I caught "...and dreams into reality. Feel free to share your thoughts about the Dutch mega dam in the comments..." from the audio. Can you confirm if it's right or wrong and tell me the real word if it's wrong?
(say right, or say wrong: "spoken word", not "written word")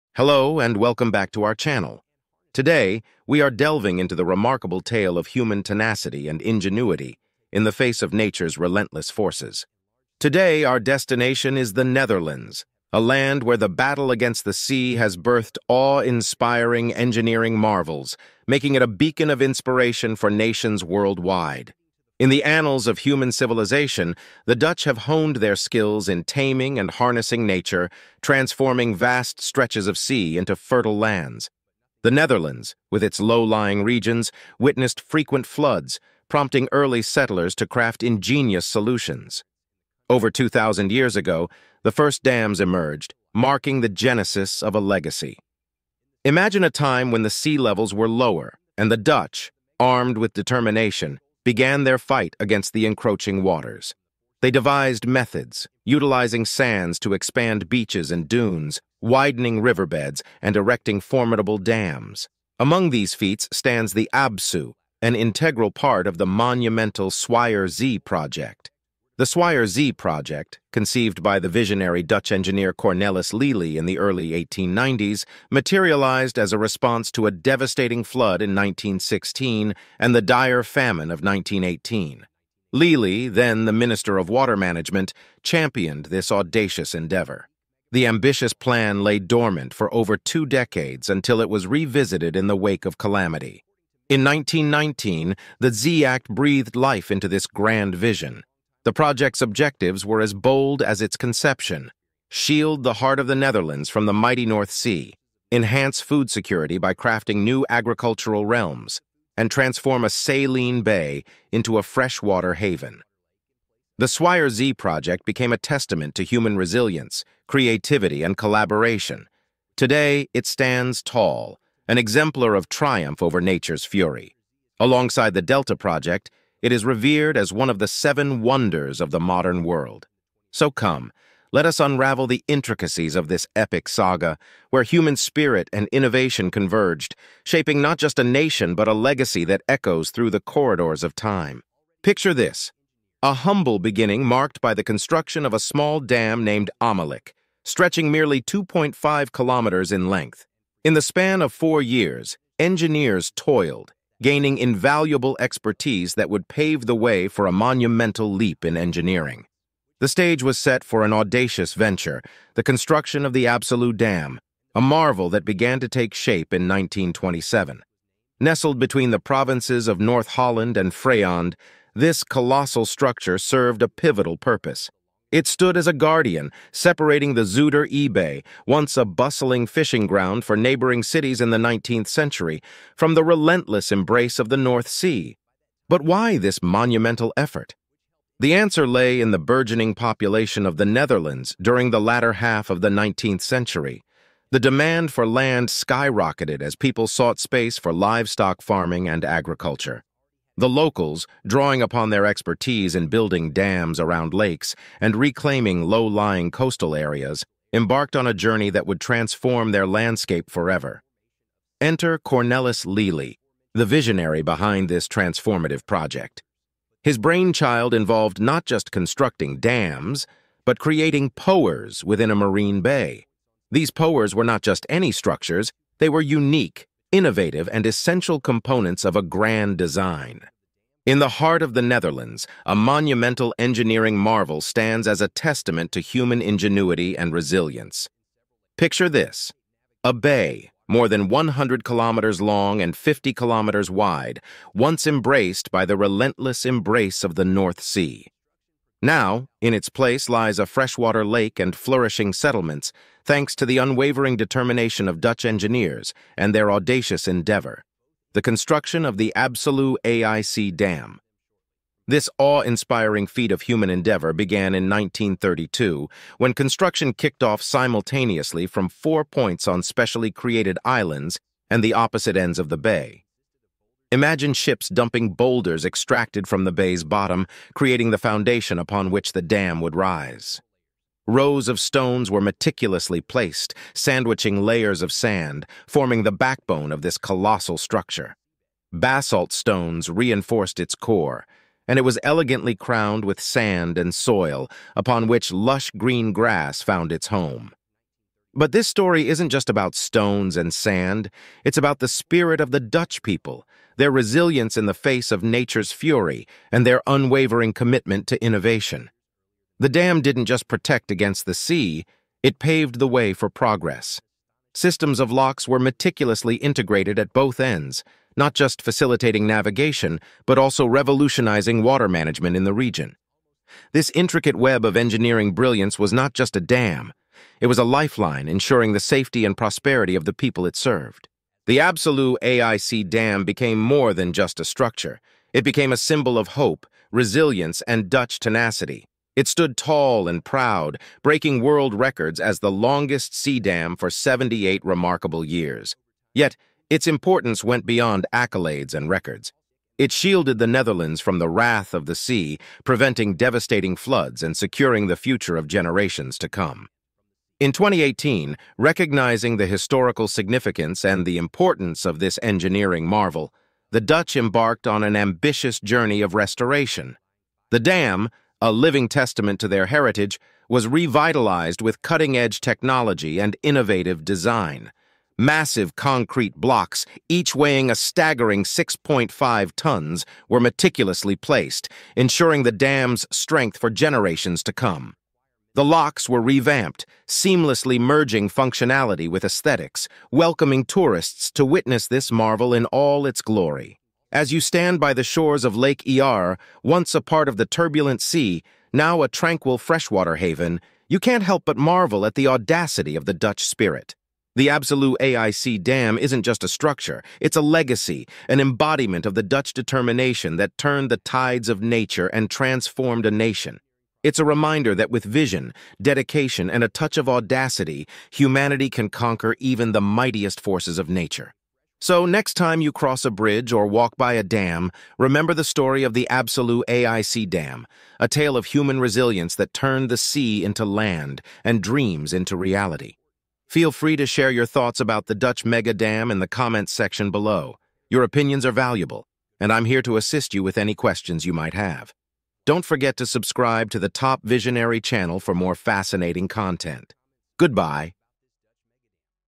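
right.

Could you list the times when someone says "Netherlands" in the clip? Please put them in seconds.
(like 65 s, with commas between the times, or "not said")
11 s, 32 s, 103 s, 190 s, 231 s, 350 s.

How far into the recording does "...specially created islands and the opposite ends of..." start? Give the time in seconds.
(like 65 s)
269 s.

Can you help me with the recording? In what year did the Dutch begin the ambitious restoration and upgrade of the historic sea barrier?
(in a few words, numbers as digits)
2018.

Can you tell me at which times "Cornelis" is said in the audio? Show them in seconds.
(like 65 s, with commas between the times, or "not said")
72 s, 212 s.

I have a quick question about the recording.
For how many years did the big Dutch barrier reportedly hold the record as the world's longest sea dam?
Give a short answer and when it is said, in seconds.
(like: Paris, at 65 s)
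78, at 344 s.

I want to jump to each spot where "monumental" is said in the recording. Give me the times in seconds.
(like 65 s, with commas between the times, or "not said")
66 s, 157 s, 186 s, 232 s.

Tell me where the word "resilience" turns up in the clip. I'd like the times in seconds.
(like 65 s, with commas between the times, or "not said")
116 s, 237 s, 304 s, 337 s, 428 s.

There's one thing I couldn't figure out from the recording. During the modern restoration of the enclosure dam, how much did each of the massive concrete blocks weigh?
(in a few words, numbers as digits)
6.5 tons.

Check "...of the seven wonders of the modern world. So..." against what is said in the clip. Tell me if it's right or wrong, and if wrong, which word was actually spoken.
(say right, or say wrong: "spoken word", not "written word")
right.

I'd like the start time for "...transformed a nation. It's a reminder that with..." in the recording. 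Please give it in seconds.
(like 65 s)
412 s.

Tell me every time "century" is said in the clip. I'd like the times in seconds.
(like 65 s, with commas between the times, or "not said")
182 s, 193 s.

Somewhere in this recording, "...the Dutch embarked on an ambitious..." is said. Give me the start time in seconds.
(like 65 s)
363 s.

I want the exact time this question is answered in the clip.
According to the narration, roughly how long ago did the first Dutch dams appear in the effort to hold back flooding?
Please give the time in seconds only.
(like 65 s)
40 s.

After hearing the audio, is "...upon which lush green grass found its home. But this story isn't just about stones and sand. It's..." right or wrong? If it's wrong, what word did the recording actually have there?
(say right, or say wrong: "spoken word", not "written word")
right.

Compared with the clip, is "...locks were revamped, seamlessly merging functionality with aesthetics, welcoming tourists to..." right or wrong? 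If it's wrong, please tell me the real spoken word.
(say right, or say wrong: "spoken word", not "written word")
right.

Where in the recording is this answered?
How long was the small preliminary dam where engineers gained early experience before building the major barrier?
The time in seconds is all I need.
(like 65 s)
148 s.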